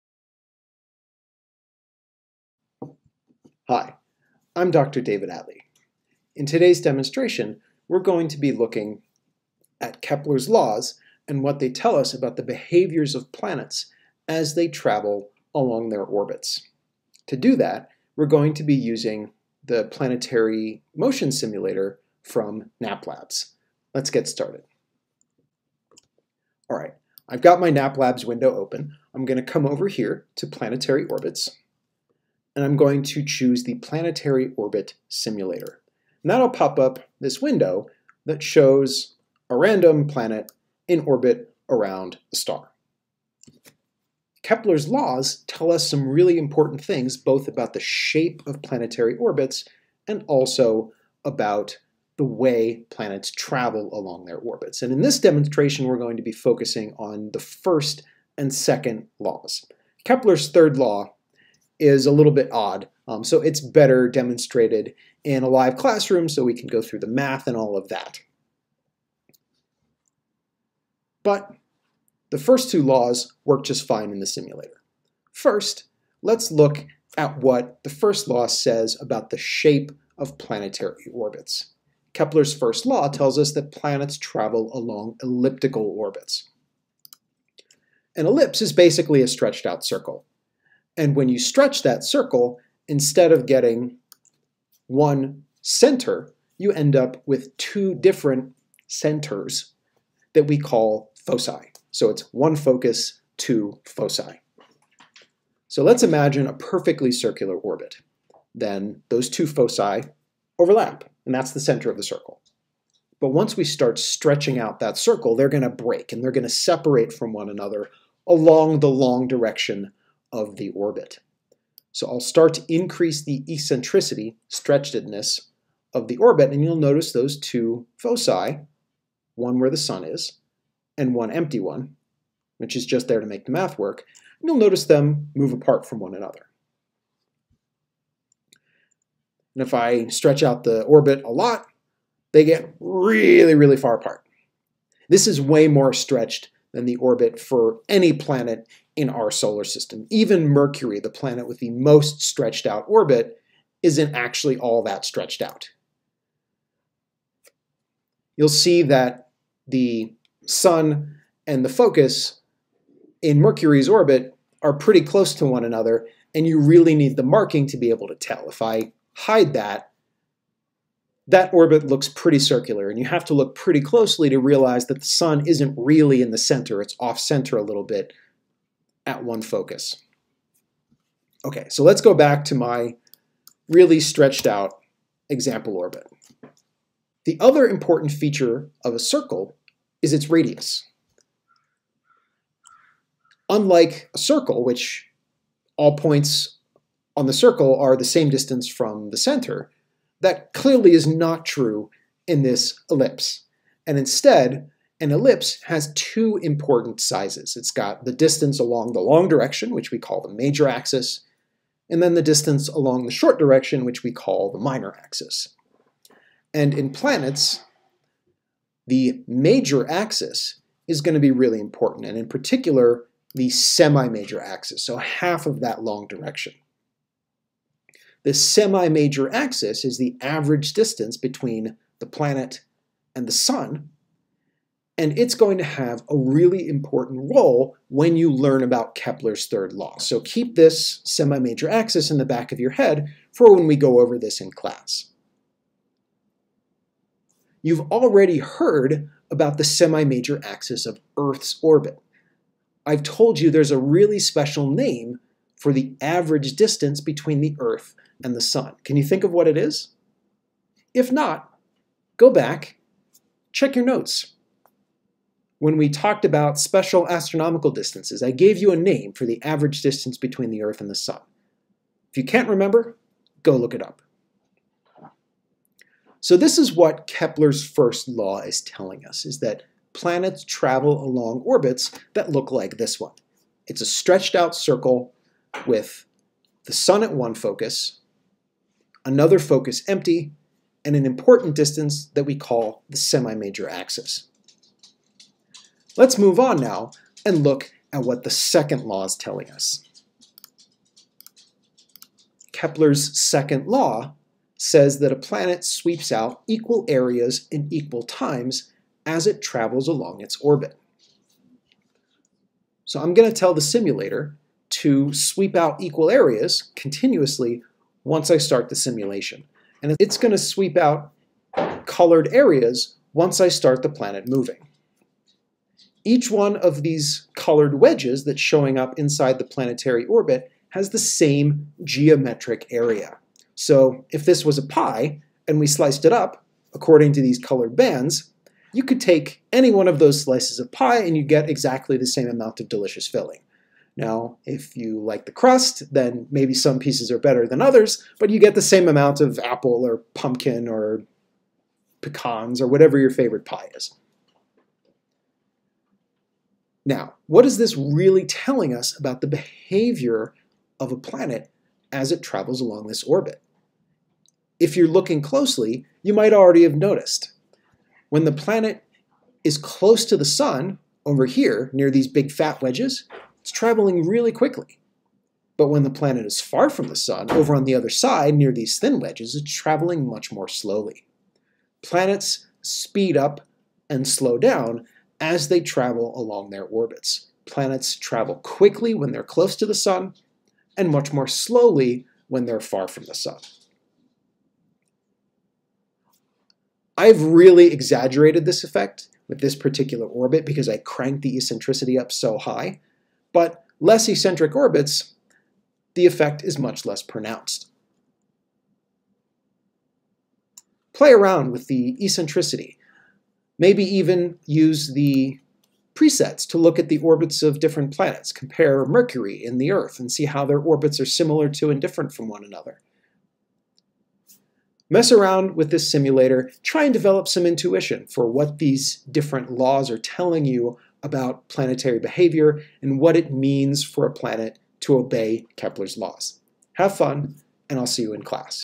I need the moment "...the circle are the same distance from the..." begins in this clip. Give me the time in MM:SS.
03:17.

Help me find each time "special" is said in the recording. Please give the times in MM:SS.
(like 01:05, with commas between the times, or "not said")
04:14, 04:26.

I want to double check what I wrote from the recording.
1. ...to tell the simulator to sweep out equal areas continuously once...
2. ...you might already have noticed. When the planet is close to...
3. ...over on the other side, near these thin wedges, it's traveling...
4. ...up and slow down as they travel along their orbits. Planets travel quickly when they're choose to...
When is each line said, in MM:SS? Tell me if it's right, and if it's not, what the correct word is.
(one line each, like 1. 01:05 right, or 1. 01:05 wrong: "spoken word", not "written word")
1. 05:13 right
2. 06:06 right
3. 06:17 right
4. 06:23 wrong: "close", not "choose".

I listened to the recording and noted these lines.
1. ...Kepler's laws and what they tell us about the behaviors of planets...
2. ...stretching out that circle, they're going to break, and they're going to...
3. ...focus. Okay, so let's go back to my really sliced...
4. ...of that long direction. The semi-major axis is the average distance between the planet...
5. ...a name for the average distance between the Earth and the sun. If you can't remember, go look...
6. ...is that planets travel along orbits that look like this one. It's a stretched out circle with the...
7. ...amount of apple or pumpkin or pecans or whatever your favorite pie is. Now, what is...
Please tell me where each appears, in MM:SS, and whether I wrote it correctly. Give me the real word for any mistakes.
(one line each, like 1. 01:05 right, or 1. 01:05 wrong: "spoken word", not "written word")
1. 00:10 right
2. 01:53 right
3. 02:59 wrong: "stretched", not "sliced"
4. 03:45 right
5. 04:28 right
6. 04:39 right
7. 05:48 right.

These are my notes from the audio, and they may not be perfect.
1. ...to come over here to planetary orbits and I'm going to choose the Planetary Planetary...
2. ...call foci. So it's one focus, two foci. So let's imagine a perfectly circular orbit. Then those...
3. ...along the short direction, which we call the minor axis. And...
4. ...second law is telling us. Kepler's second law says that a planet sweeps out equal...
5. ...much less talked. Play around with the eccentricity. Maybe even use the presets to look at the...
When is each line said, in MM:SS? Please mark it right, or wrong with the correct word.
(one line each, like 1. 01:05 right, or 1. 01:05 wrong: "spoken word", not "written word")
1. 00:29 wrong: "Orbit", not "Planetary"
2. 01:40 right
3. 03:32 right
4. 04:58 right
5. 06:46 wrong: "pronounced", not "talked".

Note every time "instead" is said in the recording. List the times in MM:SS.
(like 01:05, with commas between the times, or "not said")
01:32, 03:23.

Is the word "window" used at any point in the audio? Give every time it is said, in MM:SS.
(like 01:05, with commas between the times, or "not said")
00:28, 00:37.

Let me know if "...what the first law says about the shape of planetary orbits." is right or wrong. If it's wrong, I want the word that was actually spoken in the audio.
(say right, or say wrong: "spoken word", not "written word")
right.